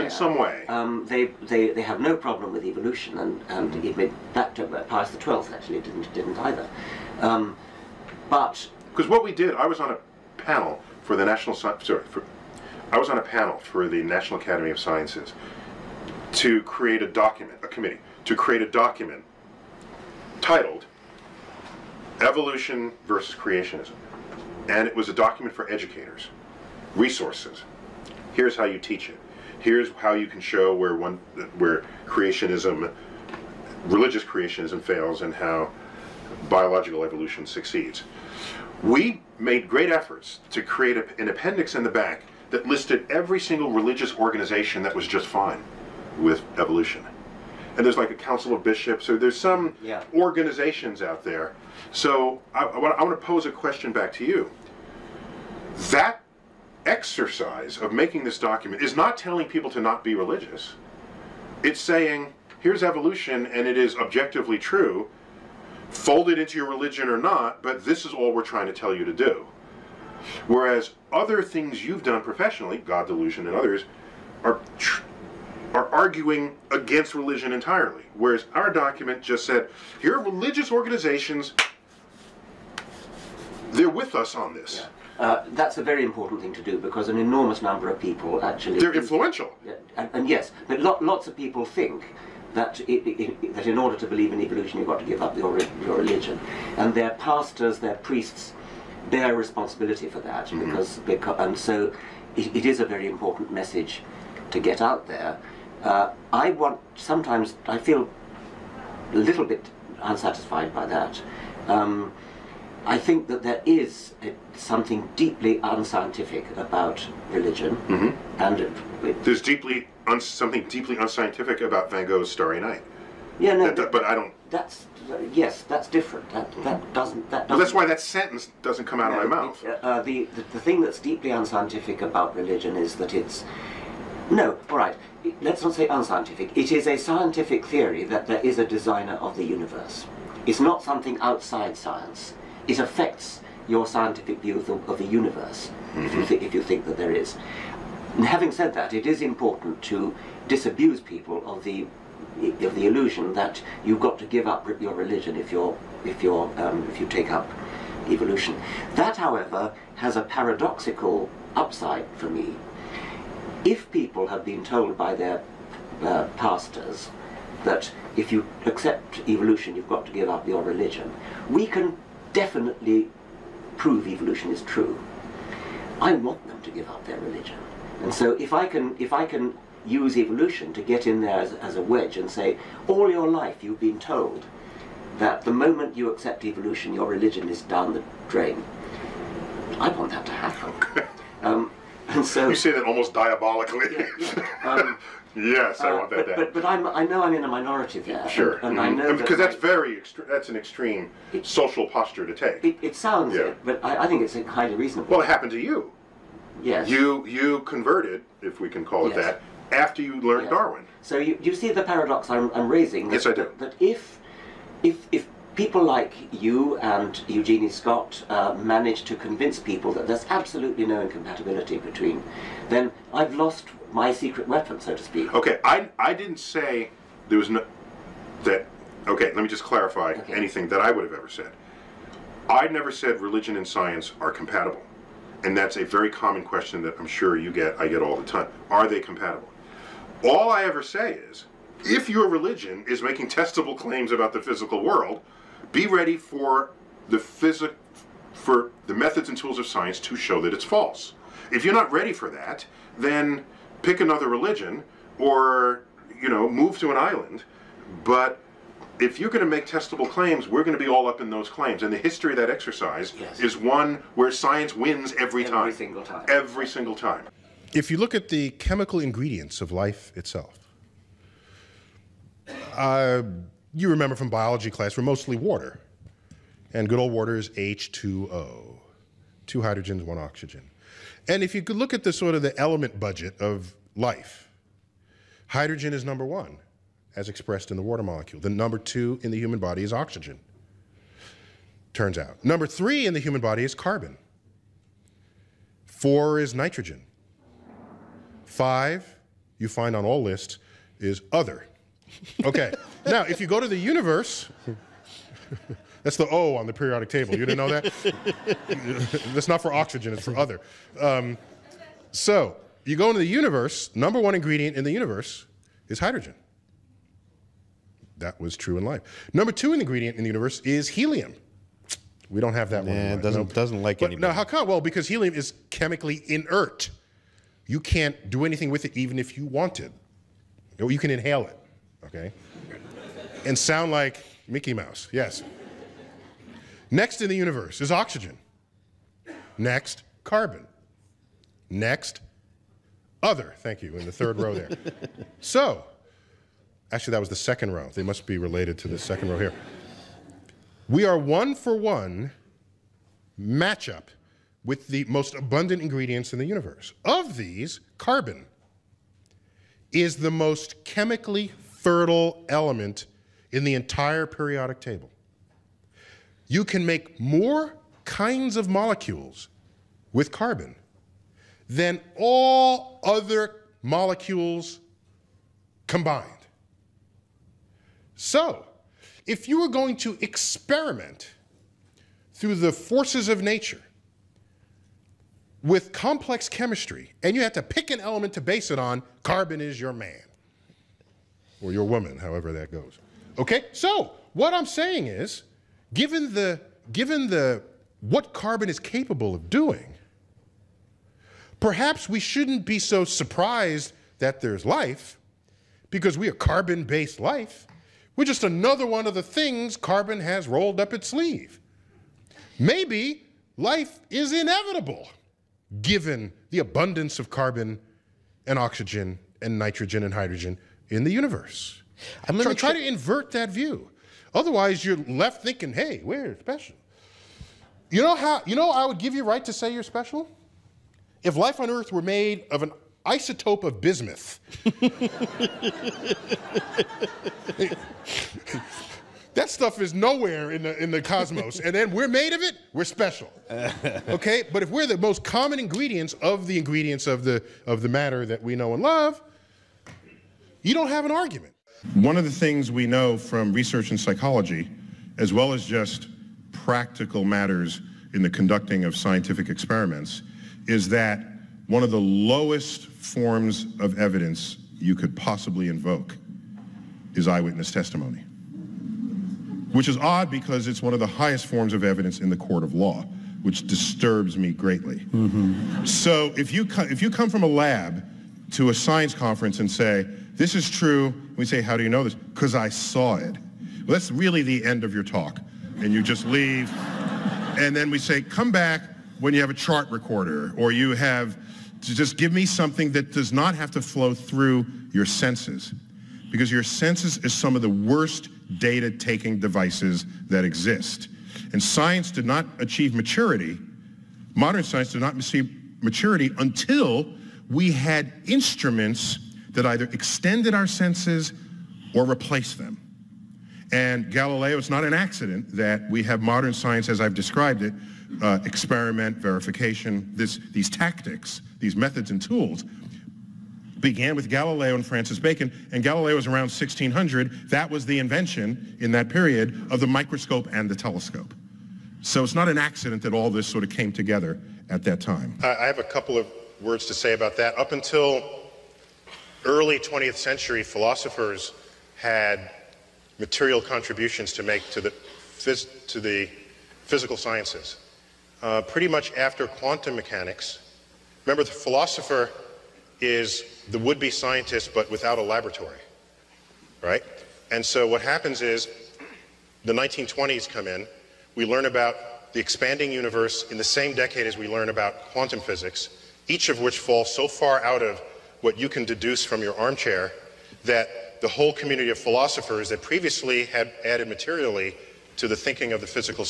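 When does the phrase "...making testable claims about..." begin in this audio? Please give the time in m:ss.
4:02.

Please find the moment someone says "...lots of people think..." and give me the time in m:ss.
1:30.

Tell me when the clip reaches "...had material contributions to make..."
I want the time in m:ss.
9:01.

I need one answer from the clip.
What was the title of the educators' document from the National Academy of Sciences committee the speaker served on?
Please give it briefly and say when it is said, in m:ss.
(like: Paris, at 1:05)
Evolution versus Creationism, at 0:22.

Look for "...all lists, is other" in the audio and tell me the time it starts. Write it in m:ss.
5:00.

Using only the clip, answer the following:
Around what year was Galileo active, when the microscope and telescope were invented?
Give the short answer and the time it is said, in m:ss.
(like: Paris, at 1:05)
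1600, at 8:46.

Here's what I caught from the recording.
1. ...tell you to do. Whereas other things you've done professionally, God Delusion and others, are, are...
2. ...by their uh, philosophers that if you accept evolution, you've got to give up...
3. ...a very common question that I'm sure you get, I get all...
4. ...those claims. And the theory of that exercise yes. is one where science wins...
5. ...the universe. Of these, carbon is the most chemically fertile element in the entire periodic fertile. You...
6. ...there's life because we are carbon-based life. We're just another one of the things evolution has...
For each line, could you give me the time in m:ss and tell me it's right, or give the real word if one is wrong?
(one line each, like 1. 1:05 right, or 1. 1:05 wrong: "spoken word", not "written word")
1. 1:08 right
2. 2:44 wrong: "pastors", not "philosophers"
3. 3:55 right
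4. 4:21 wrong: "history", not "theory"
5. 5:56 wrong: "table", not "fertile"
6. 6:44 wrong: "carbon", not "evolution".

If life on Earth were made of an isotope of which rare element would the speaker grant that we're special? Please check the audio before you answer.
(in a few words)
Bismuth.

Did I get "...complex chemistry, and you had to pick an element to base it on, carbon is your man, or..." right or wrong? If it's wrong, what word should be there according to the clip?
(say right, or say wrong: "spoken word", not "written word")
right.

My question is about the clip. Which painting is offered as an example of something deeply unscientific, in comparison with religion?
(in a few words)
Starry Night.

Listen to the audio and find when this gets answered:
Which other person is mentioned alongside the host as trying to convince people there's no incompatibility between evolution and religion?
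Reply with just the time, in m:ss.
3:37.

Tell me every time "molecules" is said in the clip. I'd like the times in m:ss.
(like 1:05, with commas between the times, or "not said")
4:48, 6:08, 6:13.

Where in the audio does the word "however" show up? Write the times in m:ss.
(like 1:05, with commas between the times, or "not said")
2:39, 6:32.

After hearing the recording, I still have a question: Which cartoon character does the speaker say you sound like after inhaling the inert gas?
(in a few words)
Mickey Mouse.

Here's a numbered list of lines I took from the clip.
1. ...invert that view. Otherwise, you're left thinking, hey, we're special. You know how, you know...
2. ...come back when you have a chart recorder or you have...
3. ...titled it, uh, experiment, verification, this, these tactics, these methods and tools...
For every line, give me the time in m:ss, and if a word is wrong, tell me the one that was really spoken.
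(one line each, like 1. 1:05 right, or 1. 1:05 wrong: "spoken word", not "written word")
1. 7:02 right
2. 8:08 right
3. 8:37 wrong: "described", not "titled".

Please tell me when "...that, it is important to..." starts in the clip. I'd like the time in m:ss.
2:28.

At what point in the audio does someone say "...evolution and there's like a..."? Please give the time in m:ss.
0:46.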